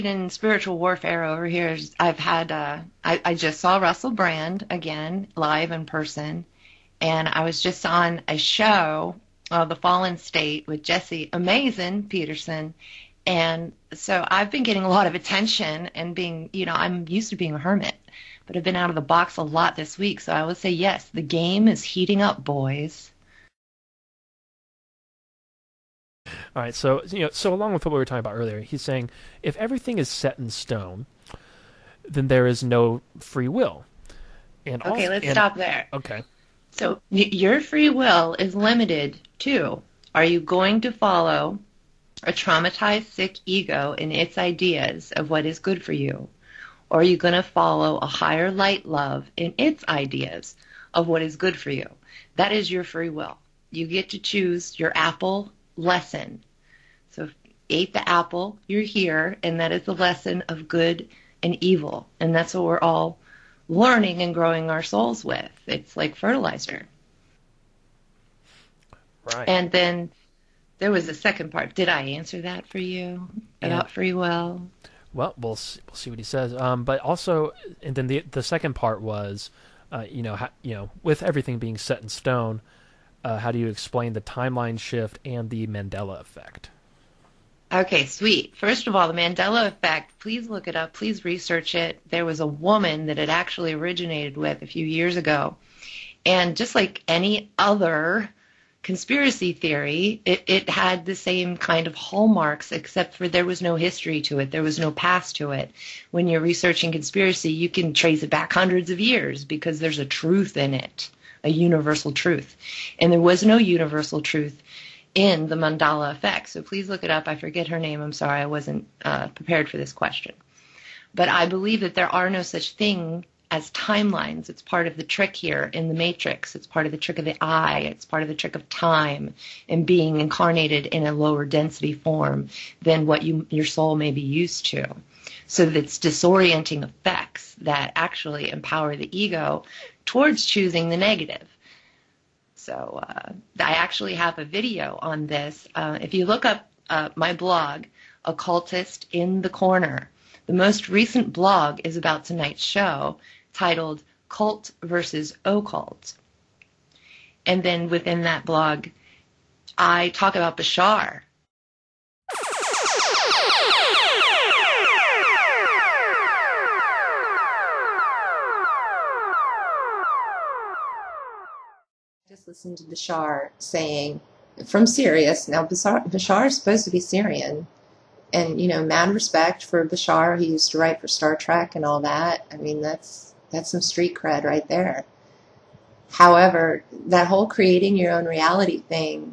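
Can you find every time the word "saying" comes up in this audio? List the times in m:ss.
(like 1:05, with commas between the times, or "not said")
0:28, 2:53.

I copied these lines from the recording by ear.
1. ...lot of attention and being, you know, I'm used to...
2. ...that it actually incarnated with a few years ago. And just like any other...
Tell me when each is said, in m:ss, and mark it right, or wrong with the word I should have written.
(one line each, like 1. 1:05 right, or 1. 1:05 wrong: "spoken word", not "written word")
1. 0:14 right
2. 1:33 wrong: "originated", not "incarnated".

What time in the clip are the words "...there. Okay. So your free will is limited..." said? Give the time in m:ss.
0:35.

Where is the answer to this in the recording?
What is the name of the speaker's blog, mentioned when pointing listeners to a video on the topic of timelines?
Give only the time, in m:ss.
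2:28.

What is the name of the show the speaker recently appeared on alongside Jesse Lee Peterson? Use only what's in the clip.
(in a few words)
The Fallen State.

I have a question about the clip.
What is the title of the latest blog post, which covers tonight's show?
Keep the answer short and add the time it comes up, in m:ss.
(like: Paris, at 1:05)
Cult versus Occult, at 2:34.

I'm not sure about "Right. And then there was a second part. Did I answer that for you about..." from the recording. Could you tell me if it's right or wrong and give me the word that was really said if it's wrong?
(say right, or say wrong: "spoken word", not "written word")
right.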